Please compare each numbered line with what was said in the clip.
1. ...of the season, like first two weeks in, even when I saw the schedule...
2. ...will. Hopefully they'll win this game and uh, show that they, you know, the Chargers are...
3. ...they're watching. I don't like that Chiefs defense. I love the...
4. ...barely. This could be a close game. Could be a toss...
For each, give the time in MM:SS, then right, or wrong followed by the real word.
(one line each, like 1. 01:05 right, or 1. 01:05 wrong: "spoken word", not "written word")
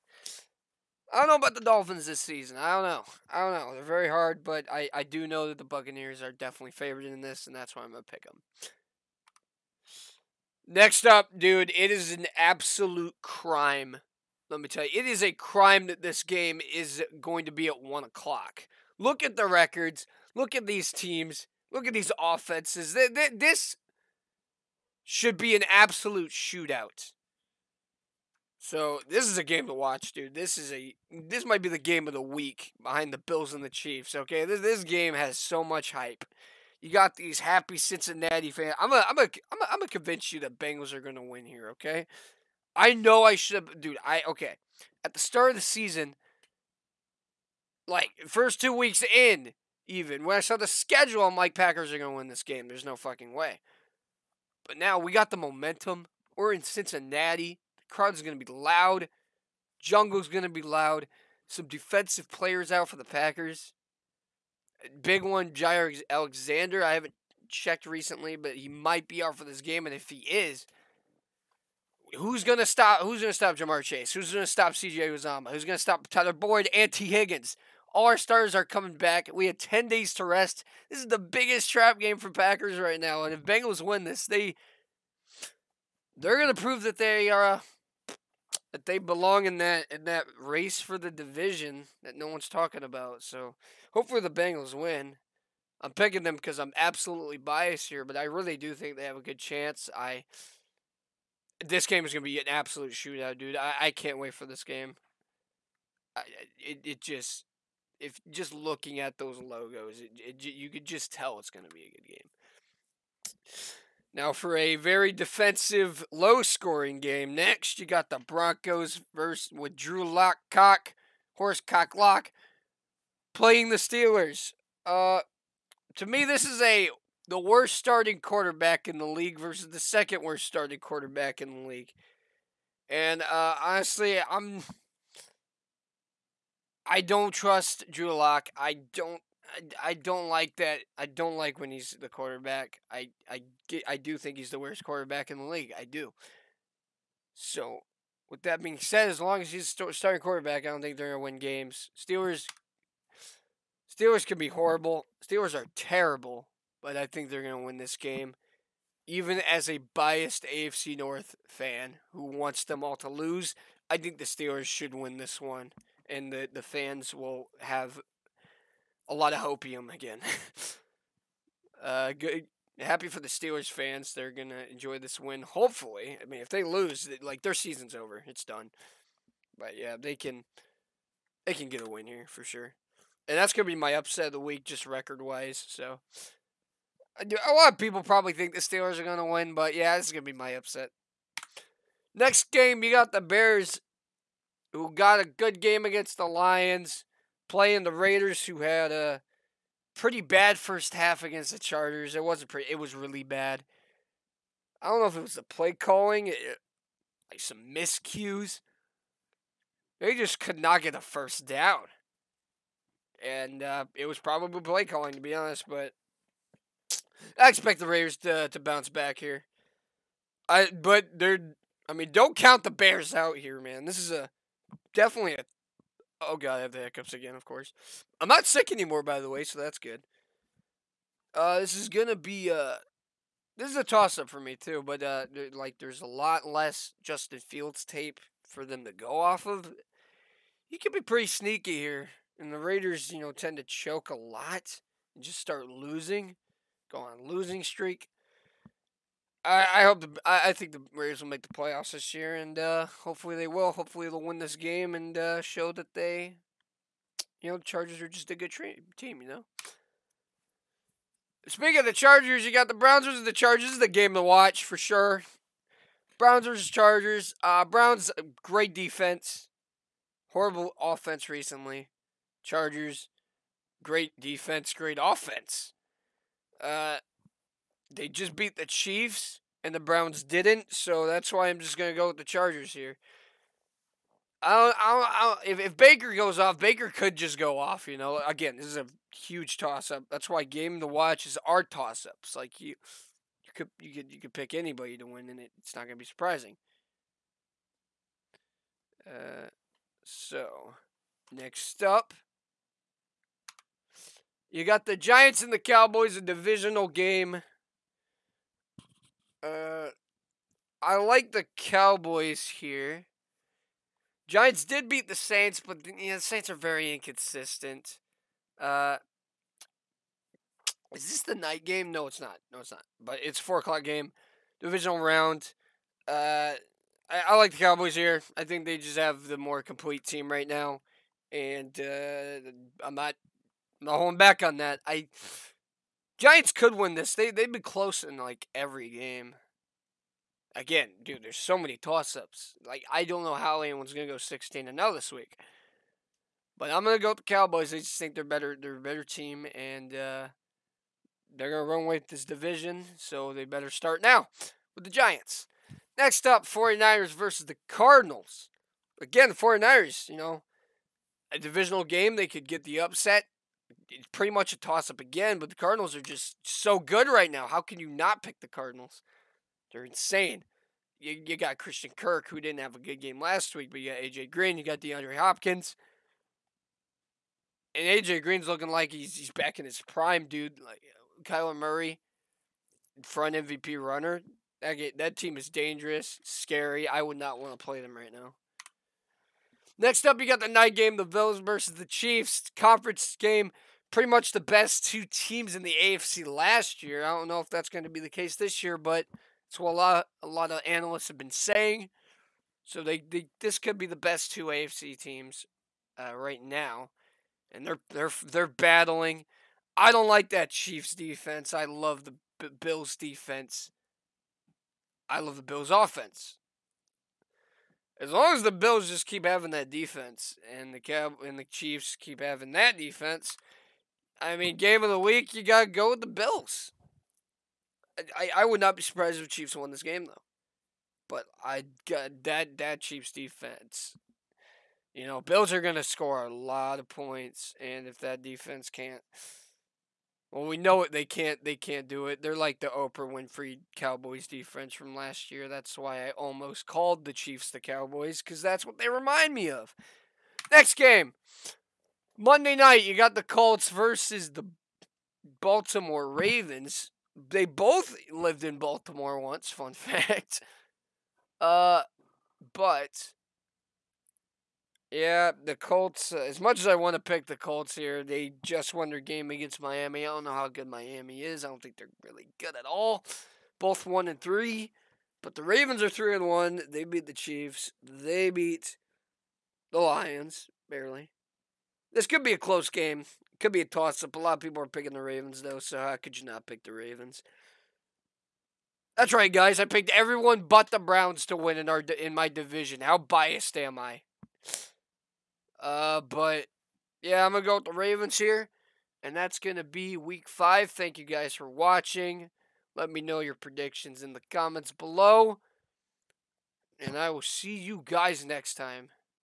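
1. 00:45 right
2. 04:13 right
3. 06:48 wrong: "battling", not "watching"
4. 08:00 right.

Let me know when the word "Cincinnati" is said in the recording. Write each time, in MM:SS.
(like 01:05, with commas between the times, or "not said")
00:37, 00:56.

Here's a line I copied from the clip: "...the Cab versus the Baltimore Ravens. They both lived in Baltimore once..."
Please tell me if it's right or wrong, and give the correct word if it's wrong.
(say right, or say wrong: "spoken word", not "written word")
wrong: "Colts", not "Cab".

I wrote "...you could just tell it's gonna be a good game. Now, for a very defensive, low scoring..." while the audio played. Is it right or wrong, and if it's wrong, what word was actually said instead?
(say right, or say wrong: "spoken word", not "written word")
right.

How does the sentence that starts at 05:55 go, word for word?
Next up, 49ers versus the Cardinals.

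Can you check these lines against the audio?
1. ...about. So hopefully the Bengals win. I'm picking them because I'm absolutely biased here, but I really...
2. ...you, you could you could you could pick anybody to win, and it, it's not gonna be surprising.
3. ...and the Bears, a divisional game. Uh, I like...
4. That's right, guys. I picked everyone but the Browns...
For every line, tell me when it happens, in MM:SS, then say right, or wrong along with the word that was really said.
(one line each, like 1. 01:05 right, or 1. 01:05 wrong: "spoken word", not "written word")
1. 01:32 right
2. 04:52 right
3. 05:05 wrong: "Cowboys", not "Bears"
4. 08:08 right.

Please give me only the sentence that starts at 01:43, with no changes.
I, I can't wait for this game.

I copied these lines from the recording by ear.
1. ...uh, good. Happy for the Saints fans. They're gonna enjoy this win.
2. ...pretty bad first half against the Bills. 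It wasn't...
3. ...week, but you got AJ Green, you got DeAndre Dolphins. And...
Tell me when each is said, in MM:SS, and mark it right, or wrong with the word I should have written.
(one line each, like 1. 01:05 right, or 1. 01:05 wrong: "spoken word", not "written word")
1. 02:51 wrong: "Steelers", not "Saints"
2. 03:19 wrong: "Chargers", not "Bills"
3. 06:13 wrong: "Hopkins", not "Dolphins".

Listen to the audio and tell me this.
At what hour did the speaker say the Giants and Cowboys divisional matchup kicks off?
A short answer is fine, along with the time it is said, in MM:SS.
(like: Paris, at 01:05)
4 o'clock, at 05:23.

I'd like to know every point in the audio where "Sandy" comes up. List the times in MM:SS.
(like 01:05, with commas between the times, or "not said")
not said.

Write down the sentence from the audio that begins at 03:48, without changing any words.
I'm not sick anymore, by the way, so that's good.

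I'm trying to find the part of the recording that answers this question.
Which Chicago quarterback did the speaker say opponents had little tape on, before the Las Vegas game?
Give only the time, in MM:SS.
03:57.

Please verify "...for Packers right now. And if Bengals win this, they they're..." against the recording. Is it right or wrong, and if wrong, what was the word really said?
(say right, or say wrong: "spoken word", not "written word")
right.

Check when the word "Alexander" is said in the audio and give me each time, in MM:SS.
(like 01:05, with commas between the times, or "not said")
01:06.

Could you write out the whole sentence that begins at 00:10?
Next up, dude, it is an absolute crime.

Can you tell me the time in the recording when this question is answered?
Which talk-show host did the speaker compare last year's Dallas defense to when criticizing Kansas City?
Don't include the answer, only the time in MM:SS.
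07:22.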